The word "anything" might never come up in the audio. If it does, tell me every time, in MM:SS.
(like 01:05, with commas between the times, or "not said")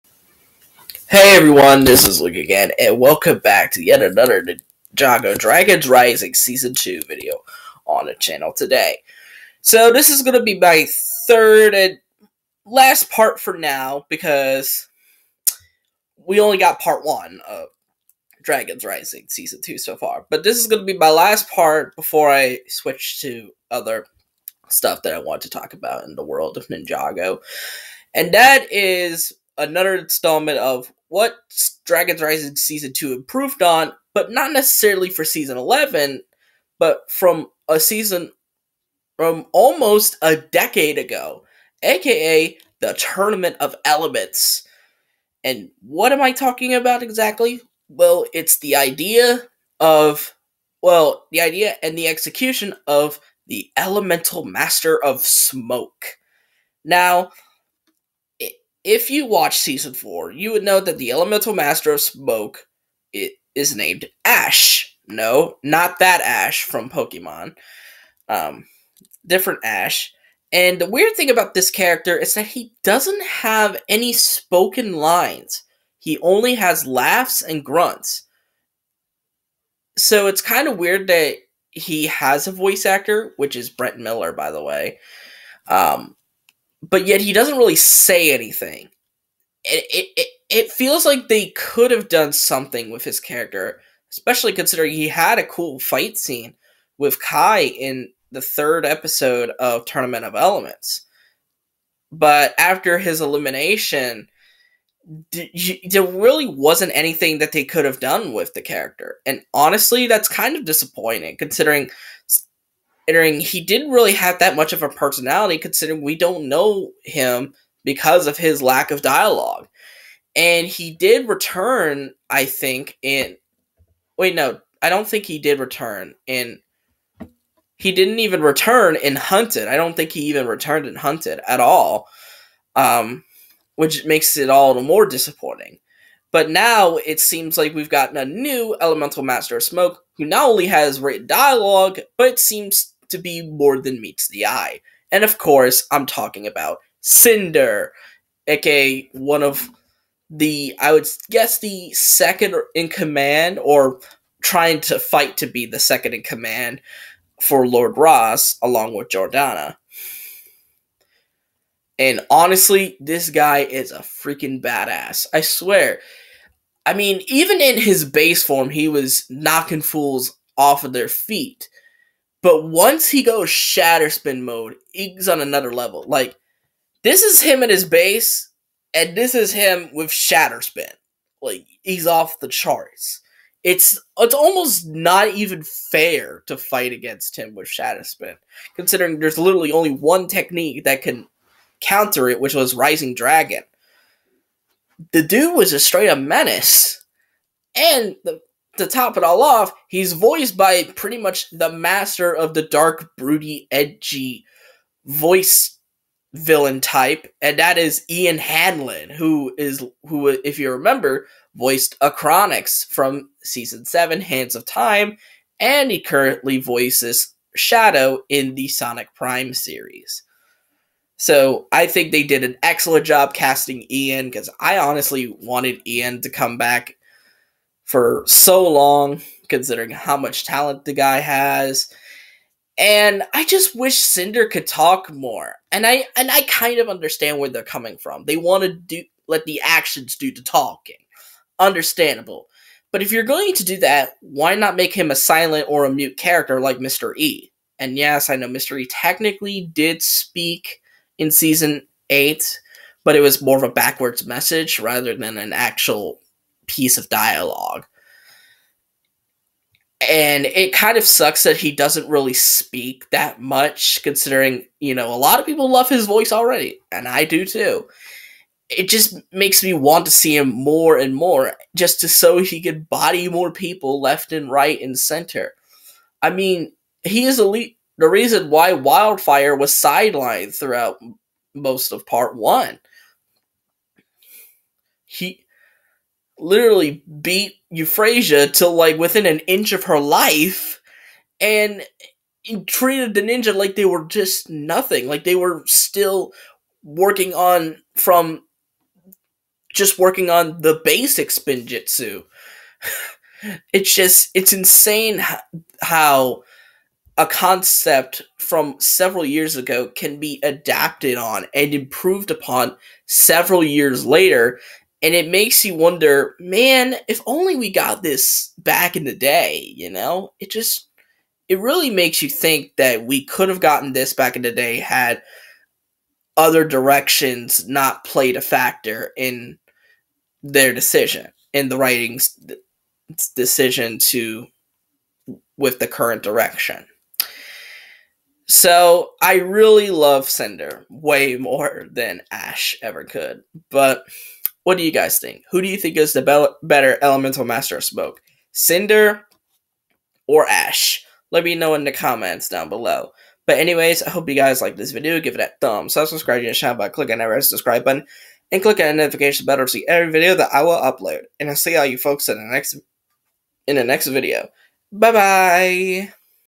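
01:28, 01:46.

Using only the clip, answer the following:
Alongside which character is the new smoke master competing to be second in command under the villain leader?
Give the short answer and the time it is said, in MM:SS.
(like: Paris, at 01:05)
Jordana, at 02:39.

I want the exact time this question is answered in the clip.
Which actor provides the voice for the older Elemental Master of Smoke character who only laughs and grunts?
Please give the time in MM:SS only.
01:23.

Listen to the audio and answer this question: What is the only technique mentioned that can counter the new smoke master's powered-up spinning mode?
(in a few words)
Rising Dragon.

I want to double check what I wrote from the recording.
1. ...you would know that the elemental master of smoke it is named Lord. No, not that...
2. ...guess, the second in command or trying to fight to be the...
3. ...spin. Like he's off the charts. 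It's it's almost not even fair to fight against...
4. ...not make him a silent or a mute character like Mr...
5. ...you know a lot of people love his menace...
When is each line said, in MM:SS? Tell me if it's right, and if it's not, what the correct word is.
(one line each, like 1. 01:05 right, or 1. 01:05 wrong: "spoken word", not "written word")
1. 01:00 wrong: "Ash", not "Lord"
2. 02:31 right
3. 03:00 right
4. 04:04 right
5. 04:24 wrong: "voice", not "menace".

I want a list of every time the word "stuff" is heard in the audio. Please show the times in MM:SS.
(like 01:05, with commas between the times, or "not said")
00:24.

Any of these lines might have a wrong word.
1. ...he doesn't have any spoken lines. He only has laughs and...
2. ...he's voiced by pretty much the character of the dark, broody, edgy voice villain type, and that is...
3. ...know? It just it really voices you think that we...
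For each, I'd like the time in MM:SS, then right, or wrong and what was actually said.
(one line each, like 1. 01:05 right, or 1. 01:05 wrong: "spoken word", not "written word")
1. 01:12 right
2. 03:19 wrong: "master", not "character"
3. 05:19 wrong: "makes", not "voices".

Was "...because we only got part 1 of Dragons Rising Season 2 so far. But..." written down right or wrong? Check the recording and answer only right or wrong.
right.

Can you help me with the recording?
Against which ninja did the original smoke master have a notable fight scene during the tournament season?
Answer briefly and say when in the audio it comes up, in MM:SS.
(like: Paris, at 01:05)
Kai, at 01:37.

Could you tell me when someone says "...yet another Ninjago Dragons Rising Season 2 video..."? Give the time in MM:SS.
00:03.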